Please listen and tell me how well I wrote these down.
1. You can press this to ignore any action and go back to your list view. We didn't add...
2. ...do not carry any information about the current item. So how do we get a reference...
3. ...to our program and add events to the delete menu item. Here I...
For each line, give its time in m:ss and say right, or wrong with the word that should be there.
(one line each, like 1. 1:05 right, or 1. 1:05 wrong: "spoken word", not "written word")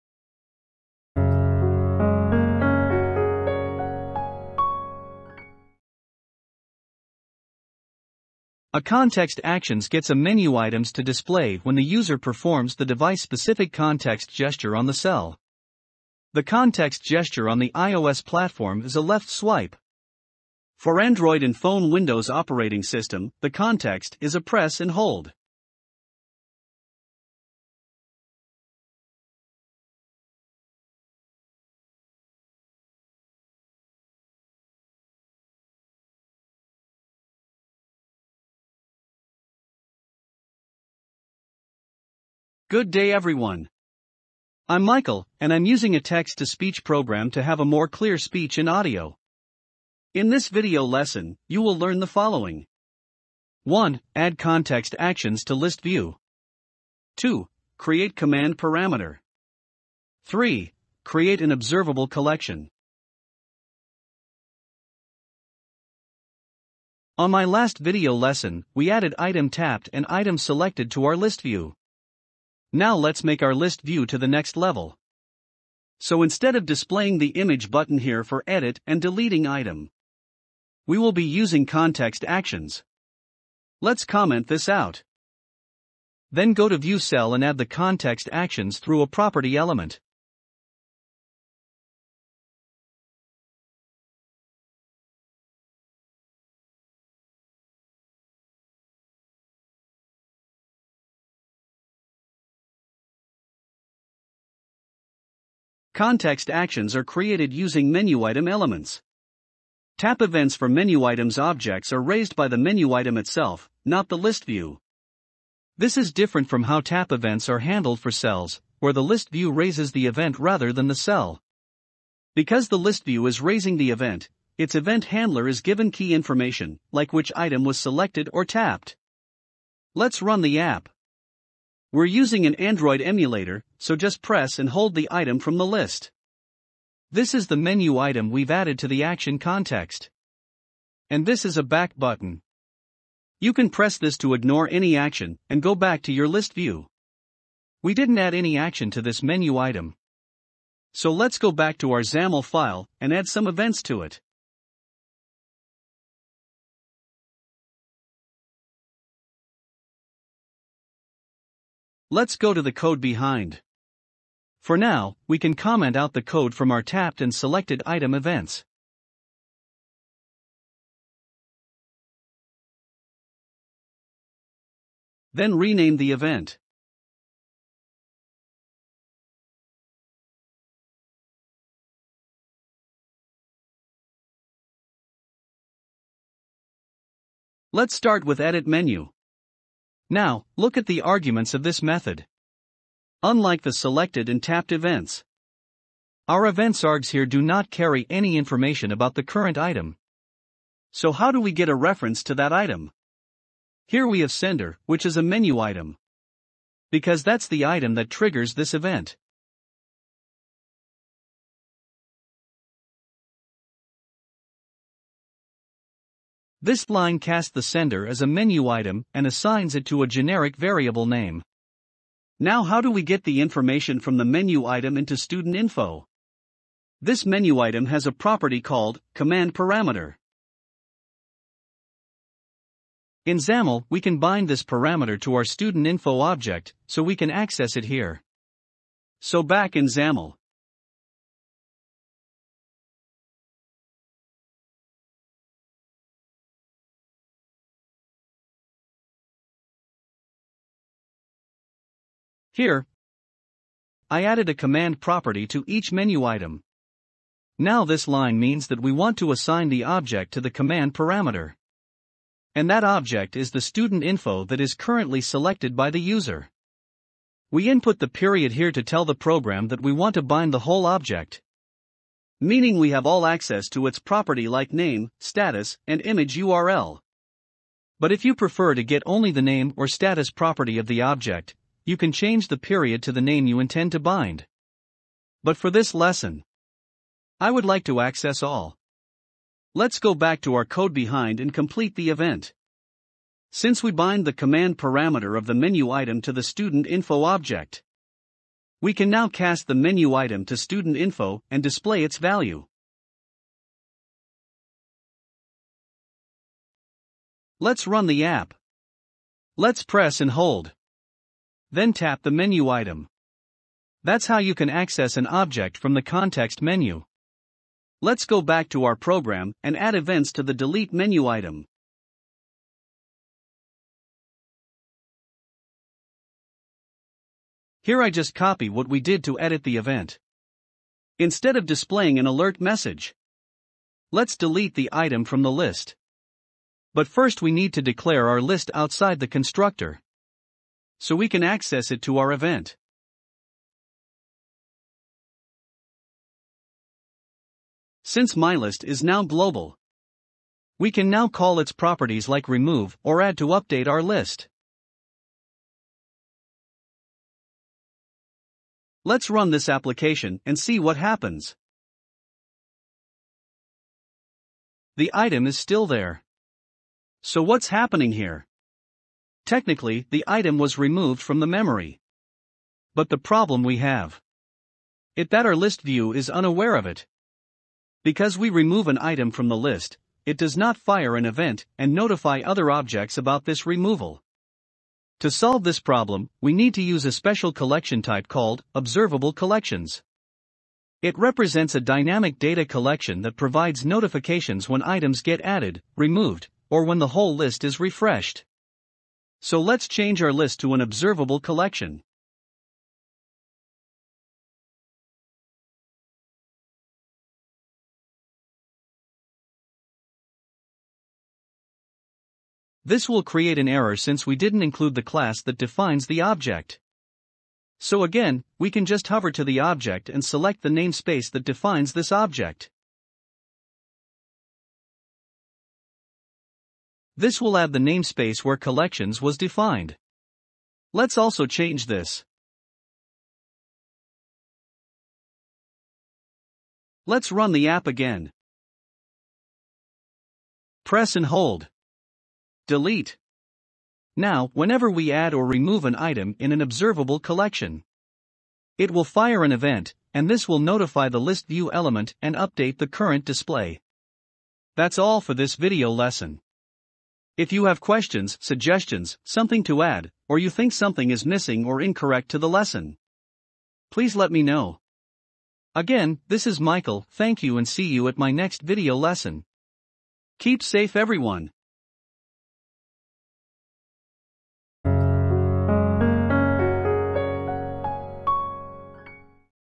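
1. 2:23 right
2. 3:17 right
3. 5:18 right.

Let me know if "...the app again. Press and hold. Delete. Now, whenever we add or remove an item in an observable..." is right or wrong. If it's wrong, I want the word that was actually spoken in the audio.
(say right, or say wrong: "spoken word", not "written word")
right.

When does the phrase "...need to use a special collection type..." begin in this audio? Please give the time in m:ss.
6:26.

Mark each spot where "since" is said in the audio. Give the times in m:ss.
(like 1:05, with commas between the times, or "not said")
4:53, 5:48, 6:53.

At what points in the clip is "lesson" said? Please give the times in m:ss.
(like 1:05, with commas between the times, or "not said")
0:50, 1:08, 4:45, 7:35, 7:42, 7:48.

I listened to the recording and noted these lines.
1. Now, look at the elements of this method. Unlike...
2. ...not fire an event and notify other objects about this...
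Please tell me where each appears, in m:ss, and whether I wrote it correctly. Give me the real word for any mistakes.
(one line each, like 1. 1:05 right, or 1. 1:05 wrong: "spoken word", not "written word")
1. 3:10 wrong: "arguments", not "elements"
2. 6:20 right.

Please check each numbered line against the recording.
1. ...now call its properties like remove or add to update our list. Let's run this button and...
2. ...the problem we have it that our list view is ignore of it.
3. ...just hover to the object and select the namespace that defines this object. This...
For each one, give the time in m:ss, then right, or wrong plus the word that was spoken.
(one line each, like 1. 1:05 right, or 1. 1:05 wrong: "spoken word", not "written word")
1. 5:51 wrong: "application", not "button"
2. 6:13 wrong: "unaware", not "ignore"
3. 6:58 right.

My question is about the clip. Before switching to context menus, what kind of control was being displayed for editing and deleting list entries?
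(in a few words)
Image button.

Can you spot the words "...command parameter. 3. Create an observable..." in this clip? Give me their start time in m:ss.
0:58.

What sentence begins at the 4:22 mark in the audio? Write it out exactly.
And that object is the student info that is currently selected by the user.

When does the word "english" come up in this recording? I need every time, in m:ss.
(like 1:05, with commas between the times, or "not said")
not said.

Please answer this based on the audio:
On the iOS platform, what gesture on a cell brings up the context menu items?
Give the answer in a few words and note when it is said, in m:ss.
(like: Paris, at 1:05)
Left swipe, at 0:19.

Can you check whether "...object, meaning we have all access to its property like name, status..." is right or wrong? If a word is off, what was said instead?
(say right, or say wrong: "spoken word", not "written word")
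right.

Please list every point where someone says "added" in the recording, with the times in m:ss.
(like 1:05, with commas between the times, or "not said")
1:08, 2:18, 4:14, 6:35.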